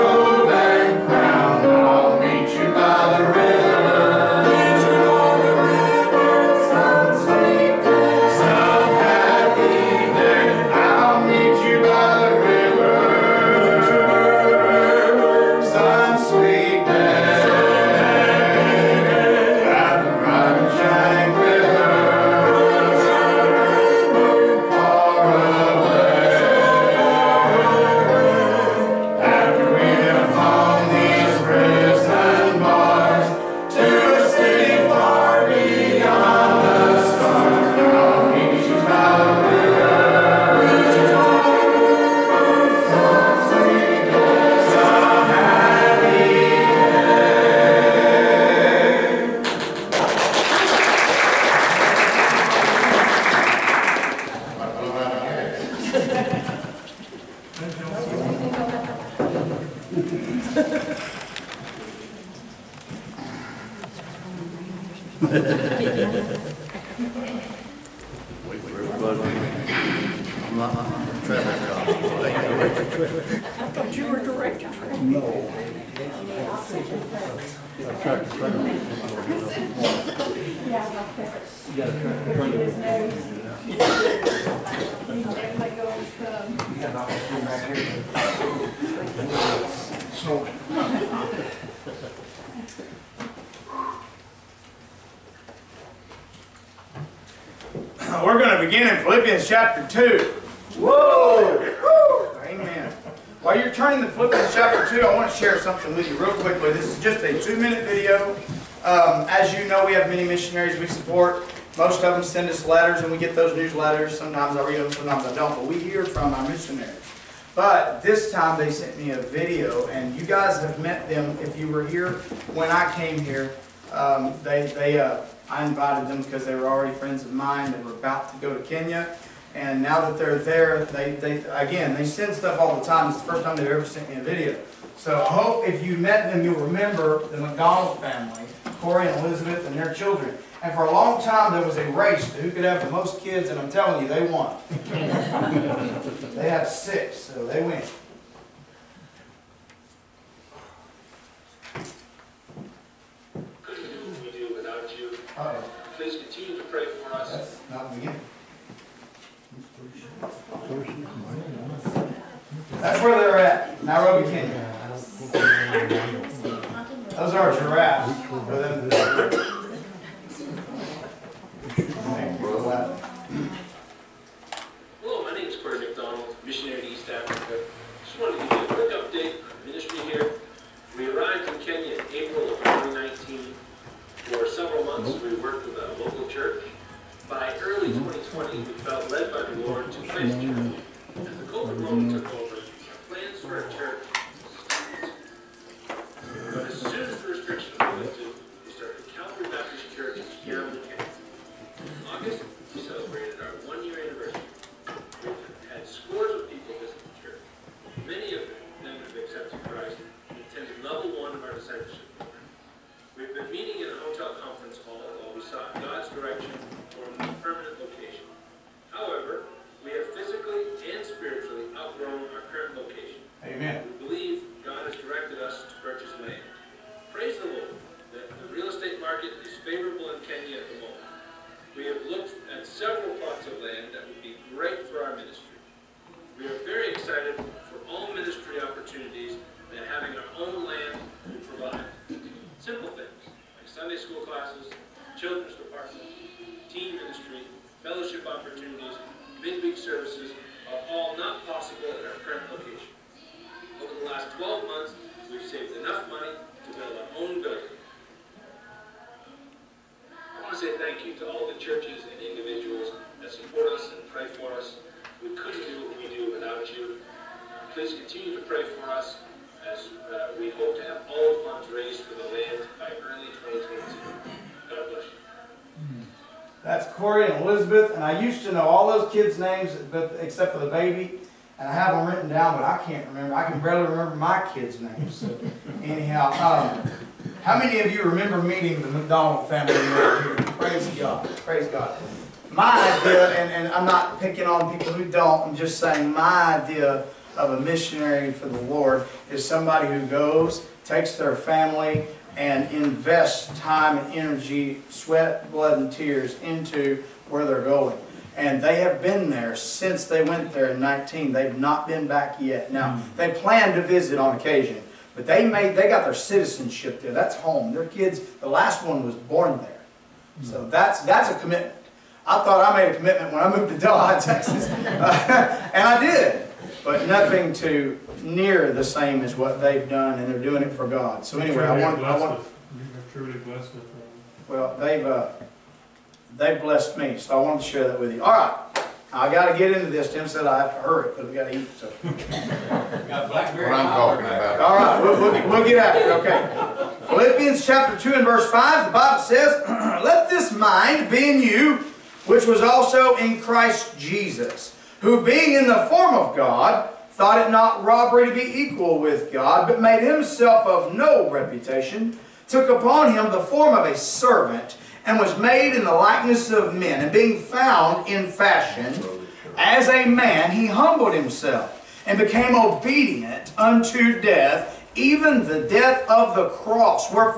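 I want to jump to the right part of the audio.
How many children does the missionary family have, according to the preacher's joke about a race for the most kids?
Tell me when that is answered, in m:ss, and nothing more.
2:26.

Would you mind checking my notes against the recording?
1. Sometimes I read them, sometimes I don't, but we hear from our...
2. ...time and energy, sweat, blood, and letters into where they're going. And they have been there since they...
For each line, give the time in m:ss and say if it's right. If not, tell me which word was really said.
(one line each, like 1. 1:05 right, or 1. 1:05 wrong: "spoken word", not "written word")
1. 1:54 right
2. 5:03 wrong: "tears", not "letters".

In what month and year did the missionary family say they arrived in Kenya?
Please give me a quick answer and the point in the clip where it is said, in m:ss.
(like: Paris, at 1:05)
April 2019, at 3:02.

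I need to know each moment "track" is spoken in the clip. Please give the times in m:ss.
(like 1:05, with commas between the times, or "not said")
1:18.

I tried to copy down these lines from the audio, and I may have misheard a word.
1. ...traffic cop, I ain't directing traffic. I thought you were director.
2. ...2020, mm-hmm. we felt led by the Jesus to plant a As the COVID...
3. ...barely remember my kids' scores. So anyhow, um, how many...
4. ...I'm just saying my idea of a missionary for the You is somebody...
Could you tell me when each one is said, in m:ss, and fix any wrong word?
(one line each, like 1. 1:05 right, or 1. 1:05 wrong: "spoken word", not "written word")
1. 1:11 right
2. 3:07 wrong: "Lord", not "Jesus"
3. 4:43 wrong: "names", not "scores"
4. 4:55 wrong: "Lord", not "You".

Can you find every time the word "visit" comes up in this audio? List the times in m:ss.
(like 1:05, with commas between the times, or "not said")
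3:26, 5:13.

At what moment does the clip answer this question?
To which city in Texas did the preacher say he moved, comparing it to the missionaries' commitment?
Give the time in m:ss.
5:23.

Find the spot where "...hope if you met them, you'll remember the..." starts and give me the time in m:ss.
2:15.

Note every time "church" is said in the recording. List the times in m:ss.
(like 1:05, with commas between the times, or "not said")
3:06, 3:13, 3:19, 3:27.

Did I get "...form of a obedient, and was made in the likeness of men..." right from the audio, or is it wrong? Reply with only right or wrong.
wrong.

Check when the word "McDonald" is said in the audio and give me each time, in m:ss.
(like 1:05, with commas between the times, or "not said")
2:17, 2:55, 4:48.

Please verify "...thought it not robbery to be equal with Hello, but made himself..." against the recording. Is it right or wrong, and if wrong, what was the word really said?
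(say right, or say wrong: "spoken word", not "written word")
wrong: "God", not "Hello".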